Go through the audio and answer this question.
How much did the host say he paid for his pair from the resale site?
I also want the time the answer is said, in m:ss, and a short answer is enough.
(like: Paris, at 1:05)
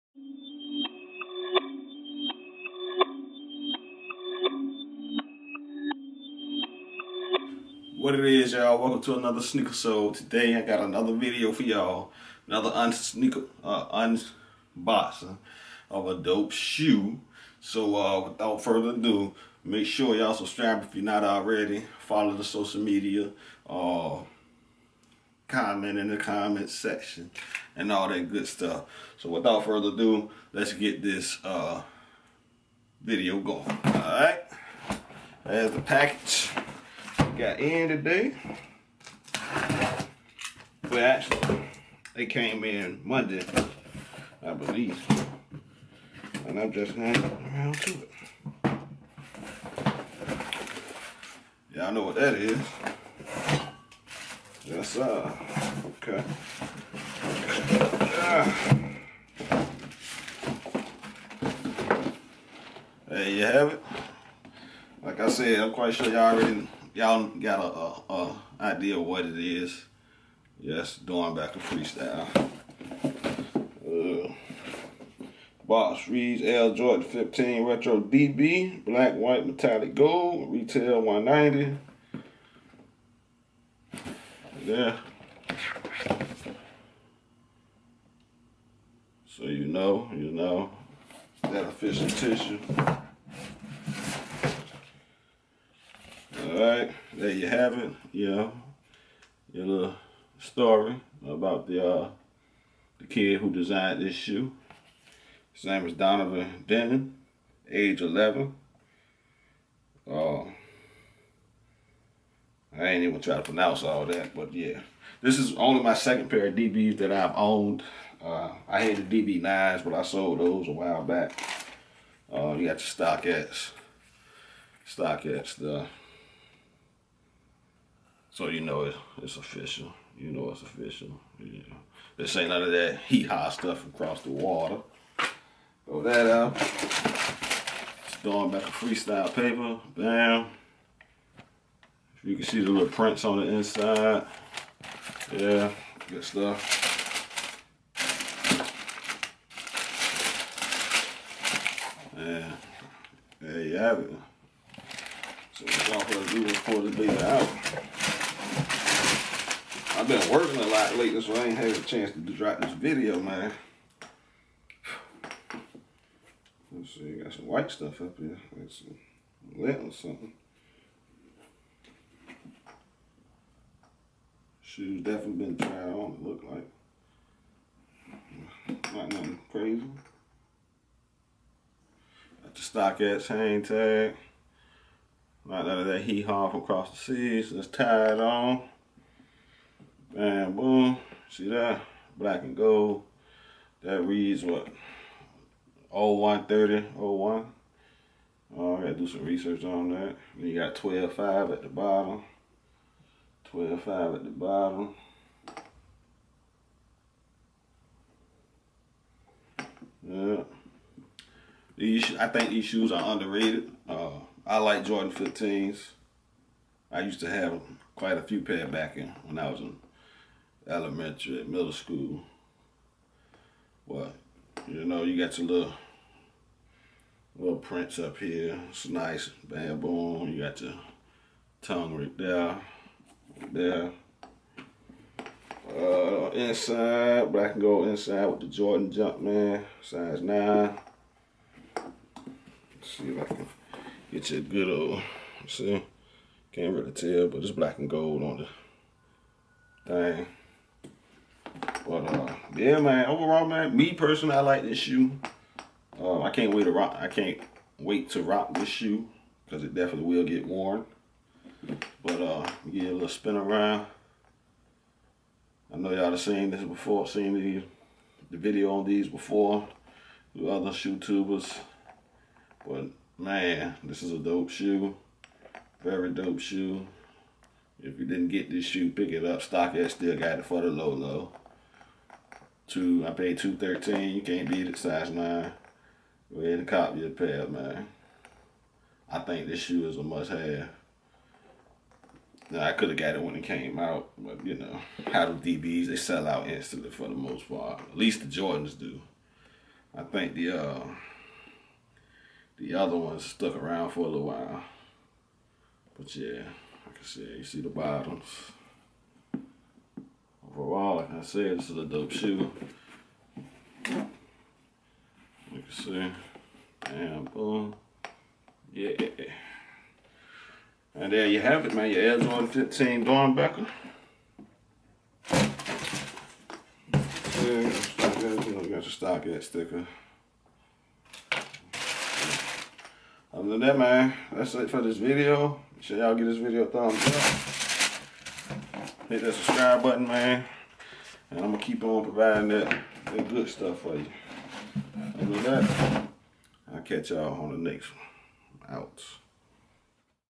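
$213, at 4:43.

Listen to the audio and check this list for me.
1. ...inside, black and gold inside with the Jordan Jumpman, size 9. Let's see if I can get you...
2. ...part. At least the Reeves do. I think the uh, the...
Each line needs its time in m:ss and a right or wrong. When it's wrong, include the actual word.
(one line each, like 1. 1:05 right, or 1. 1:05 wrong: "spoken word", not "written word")
1. 3:56 right
2. 4:57 wrong: "Jordans", not "Reeves".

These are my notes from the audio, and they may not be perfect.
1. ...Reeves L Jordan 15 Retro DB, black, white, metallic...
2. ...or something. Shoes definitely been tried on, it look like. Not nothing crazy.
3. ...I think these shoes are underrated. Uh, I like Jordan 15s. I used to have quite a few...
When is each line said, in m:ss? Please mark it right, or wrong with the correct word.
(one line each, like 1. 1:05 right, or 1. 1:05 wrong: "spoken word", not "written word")
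1. 1:16 right
2. 2:49 right
3. 3:32 right.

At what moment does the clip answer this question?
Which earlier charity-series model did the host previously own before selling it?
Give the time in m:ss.
1:59.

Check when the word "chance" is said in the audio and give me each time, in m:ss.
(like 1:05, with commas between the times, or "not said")
2:41.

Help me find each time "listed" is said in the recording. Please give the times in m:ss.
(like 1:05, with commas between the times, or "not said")
not said.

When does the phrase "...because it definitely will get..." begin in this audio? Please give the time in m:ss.
4:19.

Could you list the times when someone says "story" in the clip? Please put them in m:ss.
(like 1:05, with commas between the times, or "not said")
1:40.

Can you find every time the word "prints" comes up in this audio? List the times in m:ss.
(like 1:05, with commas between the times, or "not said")
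2:22, 3:47.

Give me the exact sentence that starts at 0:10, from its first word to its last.
Today I got another video for y'all.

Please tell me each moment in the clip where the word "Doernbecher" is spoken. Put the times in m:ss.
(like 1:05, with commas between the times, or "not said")
1:11, 2:18, 5:23.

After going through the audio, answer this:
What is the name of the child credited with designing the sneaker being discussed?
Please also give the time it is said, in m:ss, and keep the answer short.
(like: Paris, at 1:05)
Donovan Denton, at 1:45.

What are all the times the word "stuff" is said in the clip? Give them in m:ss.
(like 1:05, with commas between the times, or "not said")
0:28, 2:13, 2:26, 2:47, 5:43.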